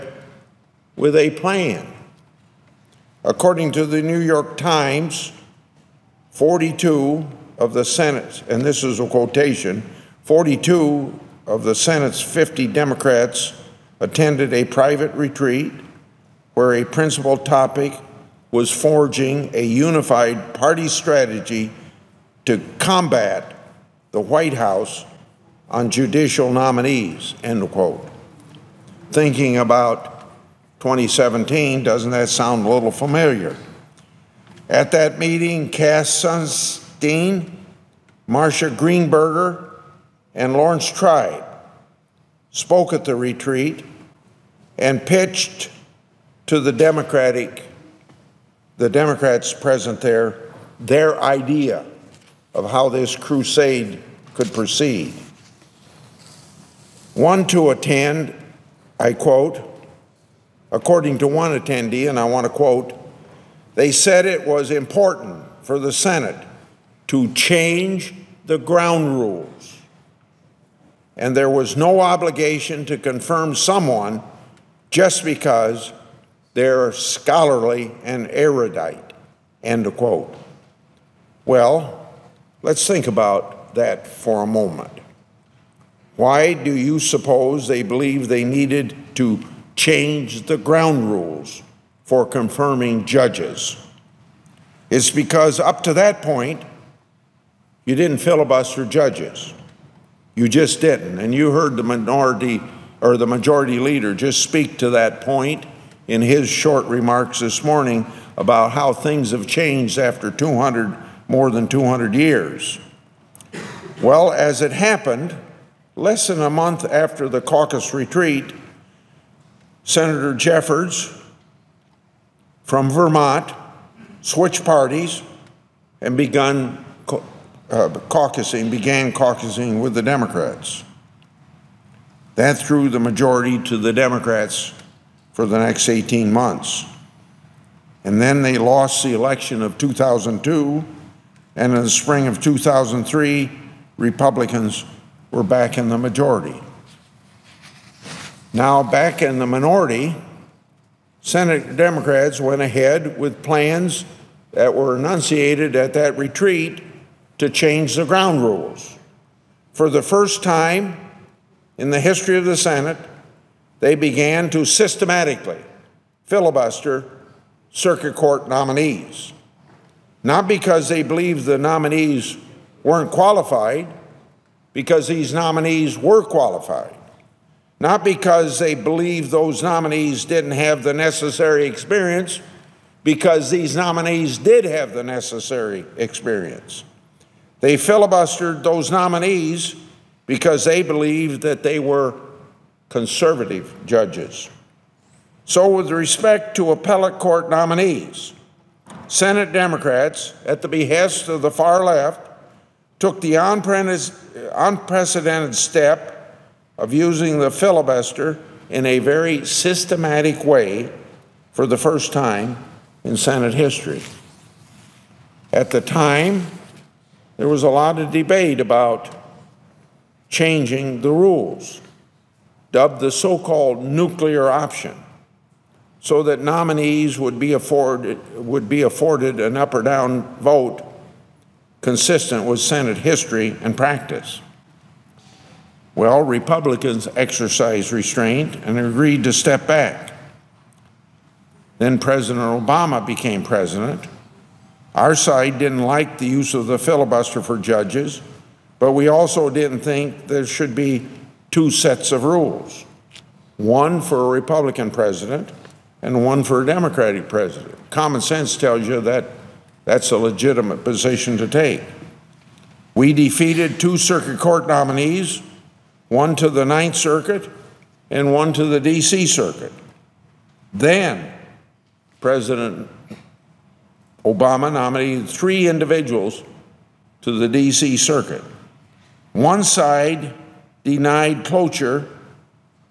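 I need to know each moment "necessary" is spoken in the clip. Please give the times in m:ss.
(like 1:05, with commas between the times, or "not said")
3:00, 3:05.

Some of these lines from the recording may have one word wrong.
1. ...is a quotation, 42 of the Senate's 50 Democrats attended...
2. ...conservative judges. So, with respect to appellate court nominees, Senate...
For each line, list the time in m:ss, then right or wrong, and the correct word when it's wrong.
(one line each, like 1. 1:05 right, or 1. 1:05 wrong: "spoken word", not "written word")
1. 0:08 right
2. 3:12 right.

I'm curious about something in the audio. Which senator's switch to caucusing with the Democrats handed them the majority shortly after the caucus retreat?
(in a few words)
Senator Jeffords.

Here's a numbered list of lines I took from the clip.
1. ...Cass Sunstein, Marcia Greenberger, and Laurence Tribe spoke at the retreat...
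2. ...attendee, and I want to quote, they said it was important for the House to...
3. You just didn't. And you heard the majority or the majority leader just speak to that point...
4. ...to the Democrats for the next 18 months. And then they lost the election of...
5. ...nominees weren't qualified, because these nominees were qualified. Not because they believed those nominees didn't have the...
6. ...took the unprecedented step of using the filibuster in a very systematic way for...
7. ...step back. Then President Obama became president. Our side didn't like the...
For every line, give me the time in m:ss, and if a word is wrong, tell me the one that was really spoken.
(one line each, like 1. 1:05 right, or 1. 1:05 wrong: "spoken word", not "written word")
1. 0:35 right
2. 1:01 wrong: "Senate", not "House"
3. 1:40 wrong: "minority", not "majority"
4. 2:13 right
5. 2:51 right
6. 3:22 right
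7. 3:59 right.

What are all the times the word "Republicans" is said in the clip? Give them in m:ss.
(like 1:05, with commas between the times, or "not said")
2:23, 3:56, 4:14.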